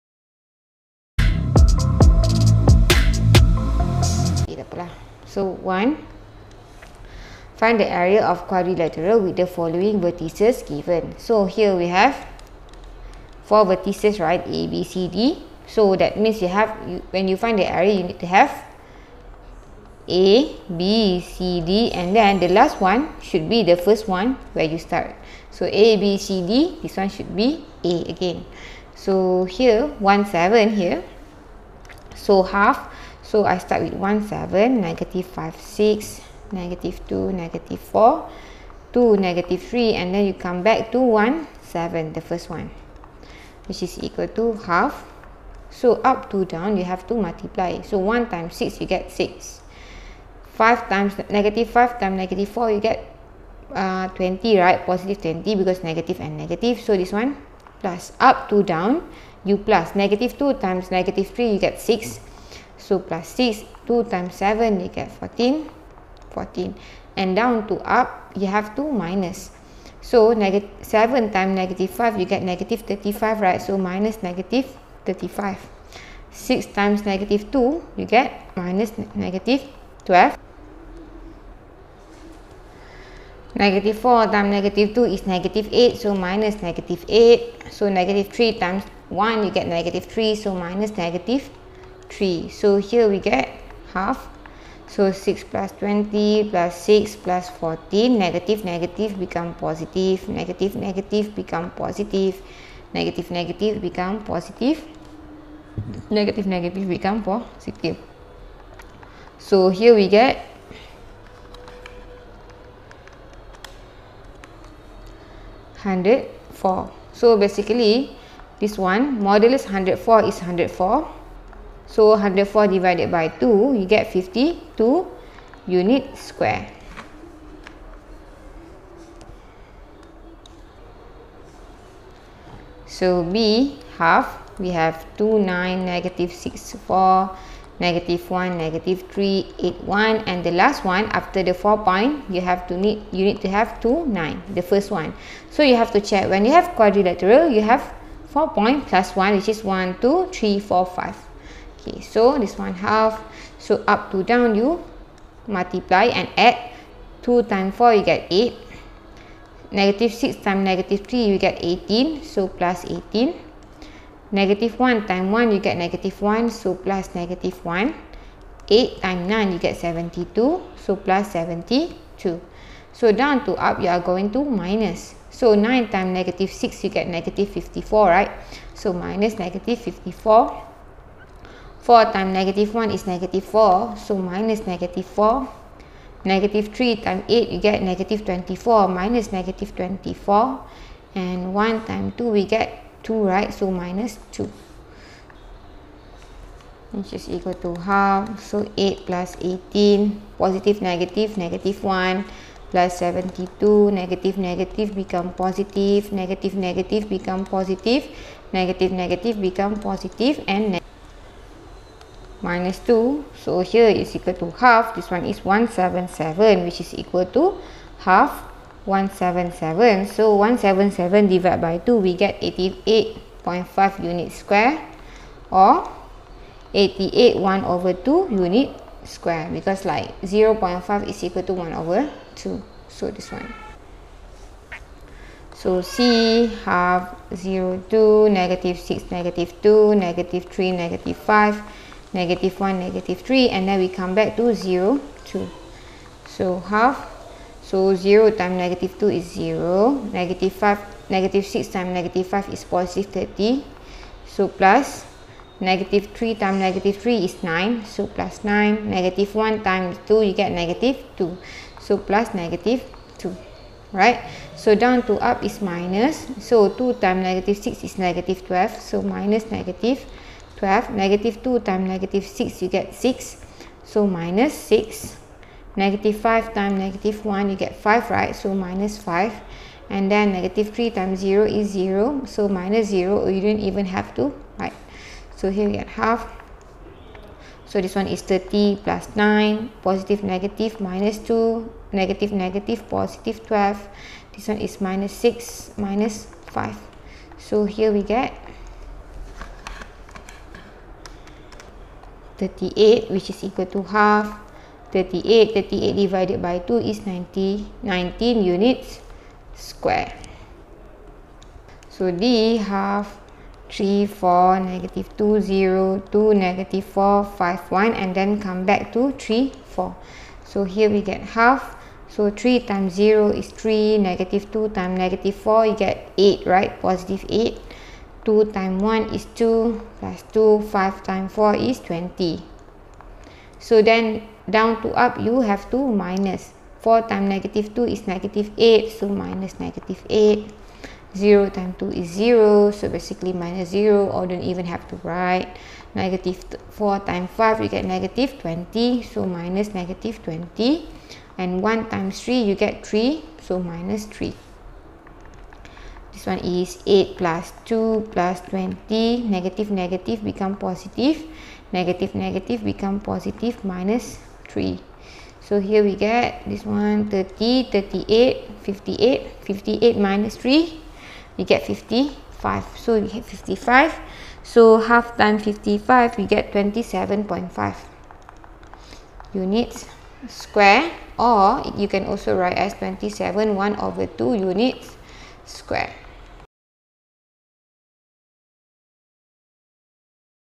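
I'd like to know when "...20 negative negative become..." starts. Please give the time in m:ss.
5:58.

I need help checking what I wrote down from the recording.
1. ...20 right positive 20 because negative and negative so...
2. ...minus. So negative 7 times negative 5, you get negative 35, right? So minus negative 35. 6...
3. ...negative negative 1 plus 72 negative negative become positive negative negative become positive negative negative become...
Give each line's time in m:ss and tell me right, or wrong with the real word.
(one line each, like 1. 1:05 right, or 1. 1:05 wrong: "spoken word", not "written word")
1. 0:54 right
2. 1:08 right
3. 3:20 right.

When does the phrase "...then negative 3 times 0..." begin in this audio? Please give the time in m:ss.
4:40.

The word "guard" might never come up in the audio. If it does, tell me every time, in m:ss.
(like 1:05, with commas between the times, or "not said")
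not said.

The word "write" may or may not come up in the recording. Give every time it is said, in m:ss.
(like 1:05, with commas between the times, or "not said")
5:45, 6:22.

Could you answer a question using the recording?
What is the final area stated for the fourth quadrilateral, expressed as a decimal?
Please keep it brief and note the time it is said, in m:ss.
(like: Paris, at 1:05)
27.5 square units, at 6:16.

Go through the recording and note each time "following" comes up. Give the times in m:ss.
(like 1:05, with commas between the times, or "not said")
0:09.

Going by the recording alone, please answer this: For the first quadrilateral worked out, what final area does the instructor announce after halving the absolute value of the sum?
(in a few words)
52 square units.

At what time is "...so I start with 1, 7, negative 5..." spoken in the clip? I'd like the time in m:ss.
0:33.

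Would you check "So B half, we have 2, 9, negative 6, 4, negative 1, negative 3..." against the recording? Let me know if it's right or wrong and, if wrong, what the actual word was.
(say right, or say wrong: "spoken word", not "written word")
right.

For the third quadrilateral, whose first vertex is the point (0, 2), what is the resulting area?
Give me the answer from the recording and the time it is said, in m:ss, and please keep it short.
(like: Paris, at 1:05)
19 square units, at 5:07.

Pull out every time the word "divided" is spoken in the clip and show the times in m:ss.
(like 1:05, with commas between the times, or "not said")
2:02, 3:41, 5:05.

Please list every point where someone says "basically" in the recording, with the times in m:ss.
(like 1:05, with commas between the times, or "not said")
1:57, 5:42.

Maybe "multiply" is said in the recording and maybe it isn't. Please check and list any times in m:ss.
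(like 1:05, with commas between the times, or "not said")
0:47, 2:35.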